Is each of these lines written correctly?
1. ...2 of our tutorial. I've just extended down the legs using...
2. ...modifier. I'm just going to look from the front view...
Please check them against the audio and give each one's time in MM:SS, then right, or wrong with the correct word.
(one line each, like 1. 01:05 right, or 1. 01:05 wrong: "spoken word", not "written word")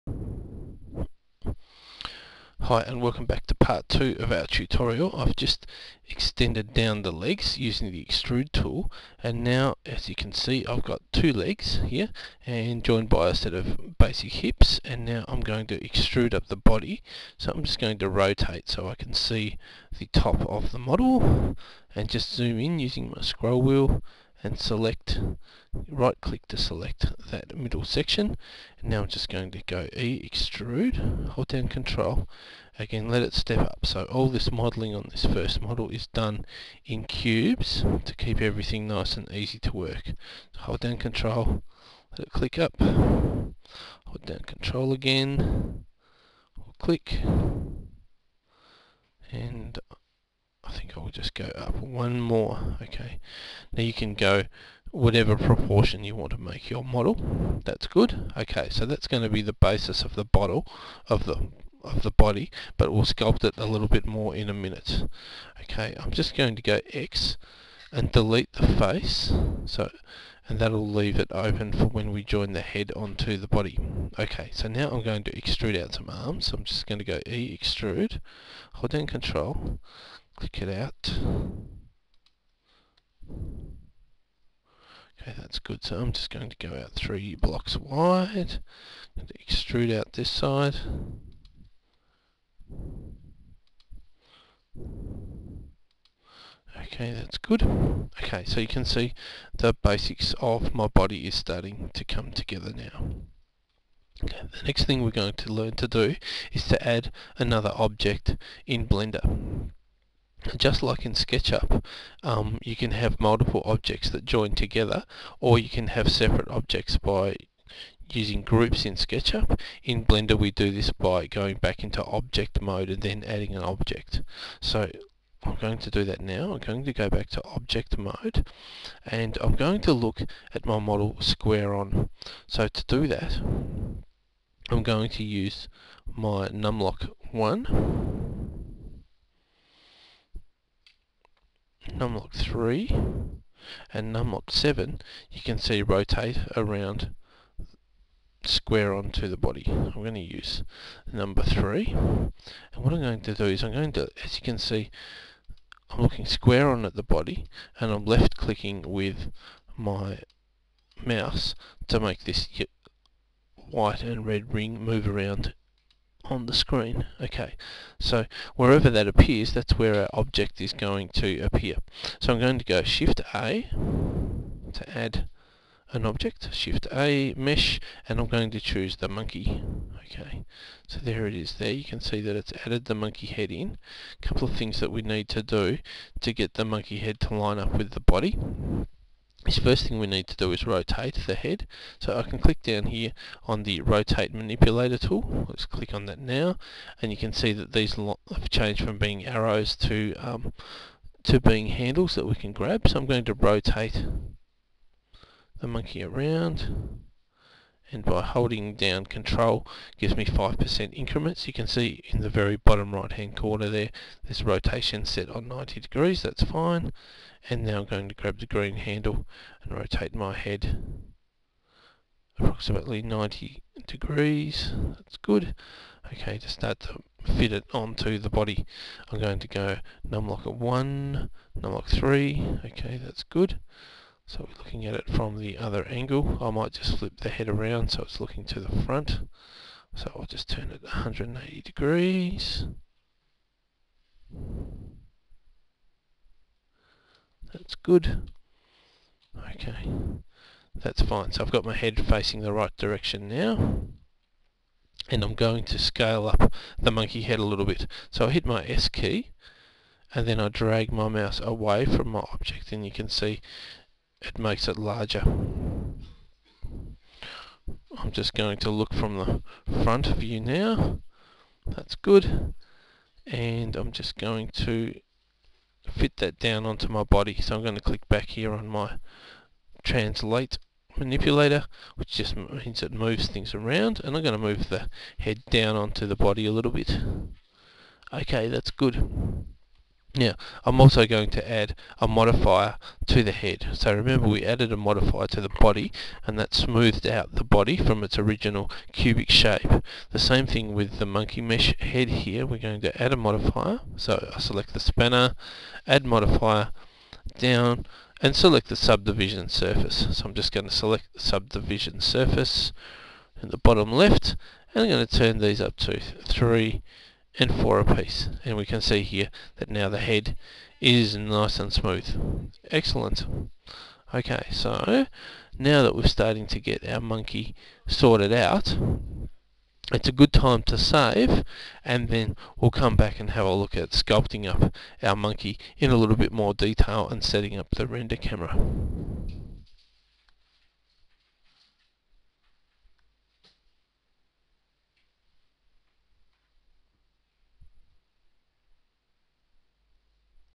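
1. 00:03 right
2. 04:24 wrong: "larger", not "modifier".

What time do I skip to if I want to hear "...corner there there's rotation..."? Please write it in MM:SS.
03:33.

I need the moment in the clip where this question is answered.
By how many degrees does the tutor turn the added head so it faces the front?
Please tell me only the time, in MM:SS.
04:00.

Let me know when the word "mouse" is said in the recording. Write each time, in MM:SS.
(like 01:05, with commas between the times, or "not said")
02:41, 04:21.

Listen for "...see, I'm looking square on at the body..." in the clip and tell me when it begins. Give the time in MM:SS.
02:34.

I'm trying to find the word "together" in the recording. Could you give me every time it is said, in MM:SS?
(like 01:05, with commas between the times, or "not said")
01:42, 01:54.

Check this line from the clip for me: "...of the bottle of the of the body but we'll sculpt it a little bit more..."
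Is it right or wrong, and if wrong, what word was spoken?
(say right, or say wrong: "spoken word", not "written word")
right.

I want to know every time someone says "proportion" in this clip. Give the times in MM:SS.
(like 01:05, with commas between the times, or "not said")
00:55.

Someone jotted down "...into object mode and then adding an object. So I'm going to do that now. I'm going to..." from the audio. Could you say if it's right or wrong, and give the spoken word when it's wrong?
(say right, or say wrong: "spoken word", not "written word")
right.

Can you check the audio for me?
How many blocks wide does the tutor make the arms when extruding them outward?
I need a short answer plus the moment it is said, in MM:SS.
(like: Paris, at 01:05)
3, at 01:26.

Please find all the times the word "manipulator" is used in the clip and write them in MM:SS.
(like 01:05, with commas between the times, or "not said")
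03:14, 04:40.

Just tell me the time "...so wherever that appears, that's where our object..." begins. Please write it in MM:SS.
02:47.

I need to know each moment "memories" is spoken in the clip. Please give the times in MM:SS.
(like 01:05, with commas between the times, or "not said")
not said.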